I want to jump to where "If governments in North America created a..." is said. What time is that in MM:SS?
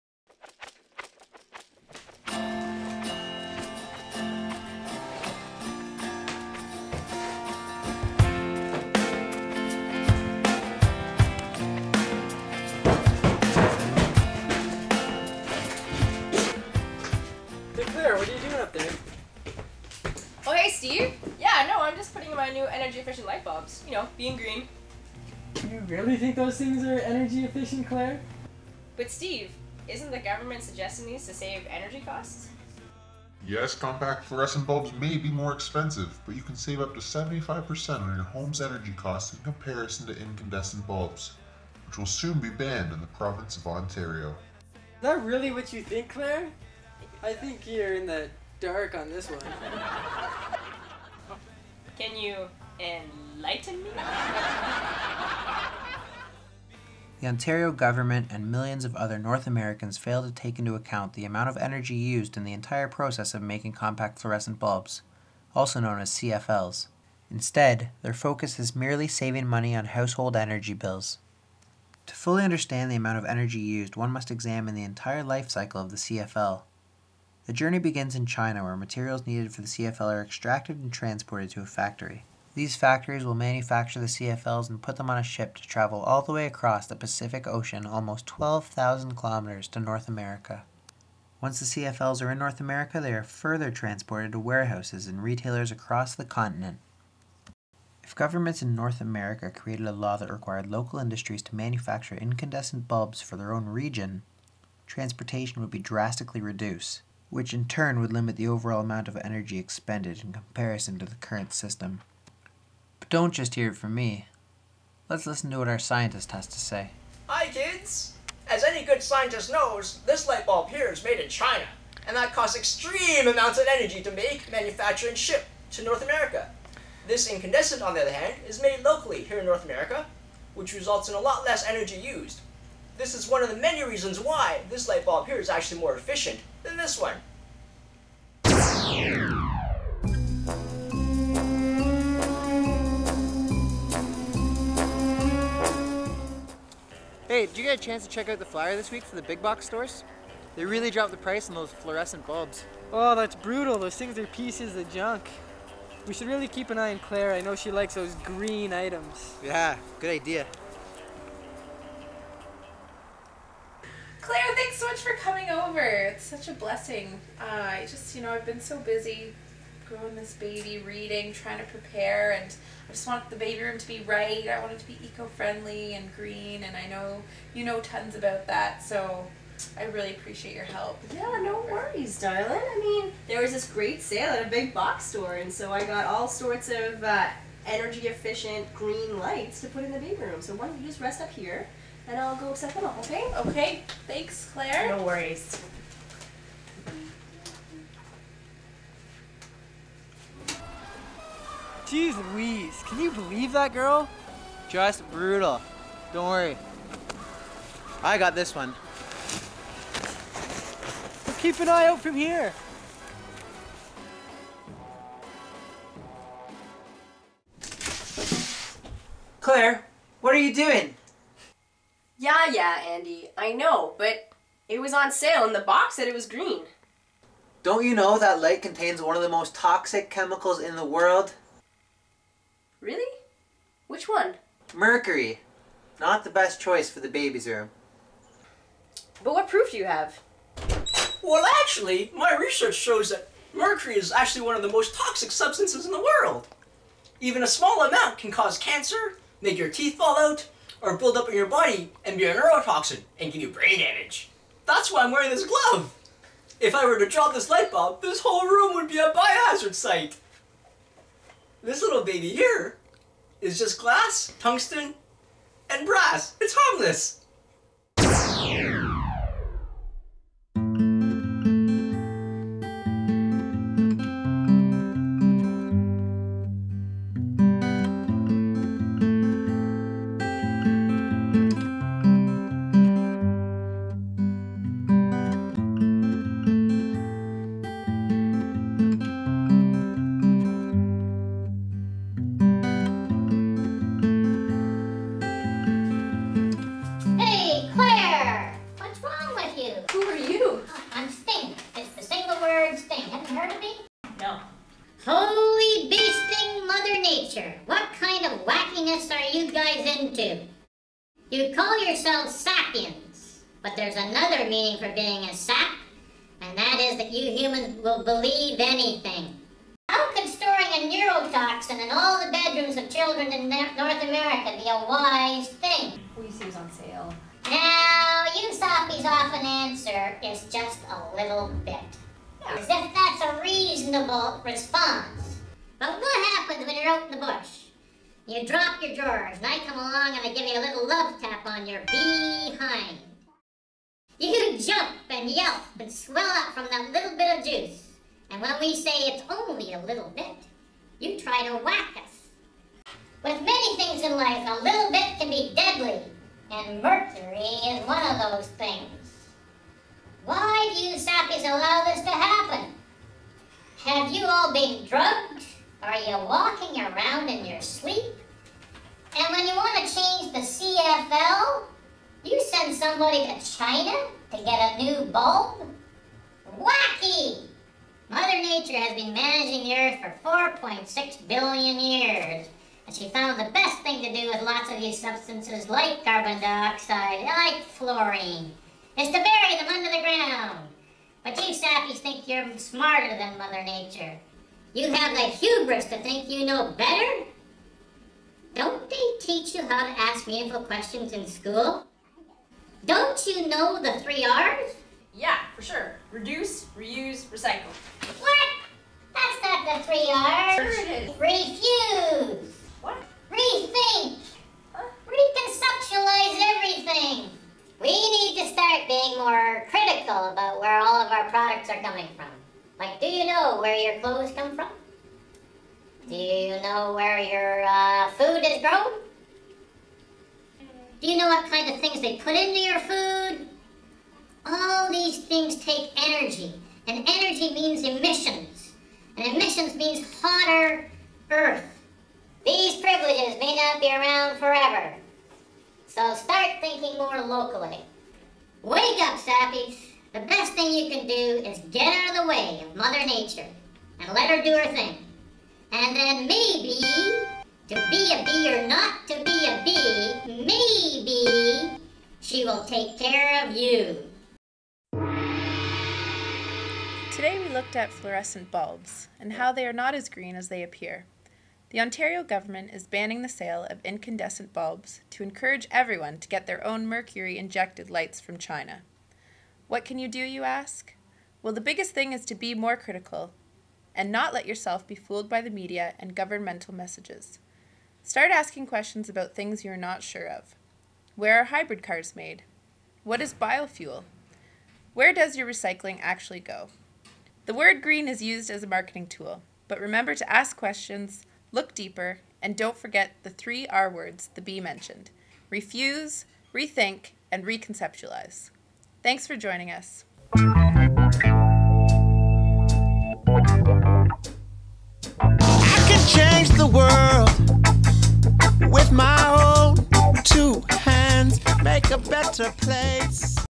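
01:38.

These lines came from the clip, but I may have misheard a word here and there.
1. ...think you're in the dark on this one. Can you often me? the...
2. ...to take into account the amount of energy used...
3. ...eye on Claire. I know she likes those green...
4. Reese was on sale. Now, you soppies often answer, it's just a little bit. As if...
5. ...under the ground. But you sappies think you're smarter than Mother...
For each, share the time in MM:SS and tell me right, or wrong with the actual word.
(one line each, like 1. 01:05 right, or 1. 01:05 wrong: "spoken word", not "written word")
1. 00:47 wrong: "enlighten", not "often"
2. 01:00 right
3. 02:36 right
4. 05:26 right
5. 06:29 right.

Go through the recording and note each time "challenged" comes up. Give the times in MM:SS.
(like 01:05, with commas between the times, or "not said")
not said.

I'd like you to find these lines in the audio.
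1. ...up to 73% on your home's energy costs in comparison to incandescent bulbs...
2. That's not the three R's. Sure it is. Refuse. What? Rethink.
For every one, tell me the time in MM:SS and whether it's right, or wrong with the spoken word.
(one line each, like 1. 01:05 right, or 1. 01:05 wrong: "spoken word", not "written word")
1. 00:36 wrong: "75", not "73"
2. 06:49 right.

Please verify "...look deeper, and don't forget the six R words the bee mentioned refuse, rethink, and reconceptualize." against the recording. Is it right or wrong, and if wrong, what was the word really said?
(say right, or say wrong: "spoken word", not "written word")
wrong: "three", not "six".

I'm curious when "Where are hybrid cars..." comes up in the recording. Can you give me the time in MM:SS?
08:11.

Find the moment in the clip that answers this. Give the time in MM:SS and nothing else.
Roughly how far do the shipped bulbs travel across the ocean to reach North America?
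01:28.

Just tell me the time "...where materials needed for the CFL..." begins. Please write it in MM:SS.
01:18.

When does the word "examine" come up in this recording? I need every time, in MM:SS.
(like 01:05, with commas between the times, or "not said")
01:14.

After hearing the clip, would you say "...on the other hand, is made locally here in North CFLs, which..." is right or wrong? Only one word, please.
wrong.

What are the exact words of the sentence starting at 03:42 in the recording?
Yeah, yeah, Andy, I know, but it was on sale and the box said it was green.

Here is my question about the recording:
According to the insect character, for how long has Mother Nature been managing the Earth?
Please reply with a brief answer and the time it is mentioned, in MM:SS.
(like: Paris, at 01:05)
4.6 billion years, at 06:20.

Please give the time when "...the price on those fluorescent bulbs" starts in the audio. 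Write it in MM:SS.
02:31.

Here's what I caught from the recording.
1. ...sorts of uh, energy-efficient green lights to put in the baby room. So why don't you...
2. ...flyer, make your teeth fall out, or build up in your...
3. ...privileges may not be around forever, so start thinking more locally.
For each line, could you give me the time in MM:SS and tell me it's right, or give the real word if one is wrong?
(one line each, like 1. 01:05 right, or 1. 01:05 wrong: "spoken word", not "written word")
1. 03:06 right
2. 04:08 wrong: "cancer", not "flyer"
3. 07:22 right.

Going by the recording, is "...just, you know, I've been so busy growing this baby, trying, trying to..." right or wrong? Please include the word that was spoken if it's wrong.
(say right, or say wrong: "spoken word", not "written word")
wrong: "reading", not "trying".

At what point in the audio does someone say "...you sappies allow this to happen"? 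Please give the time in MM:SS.
06:00.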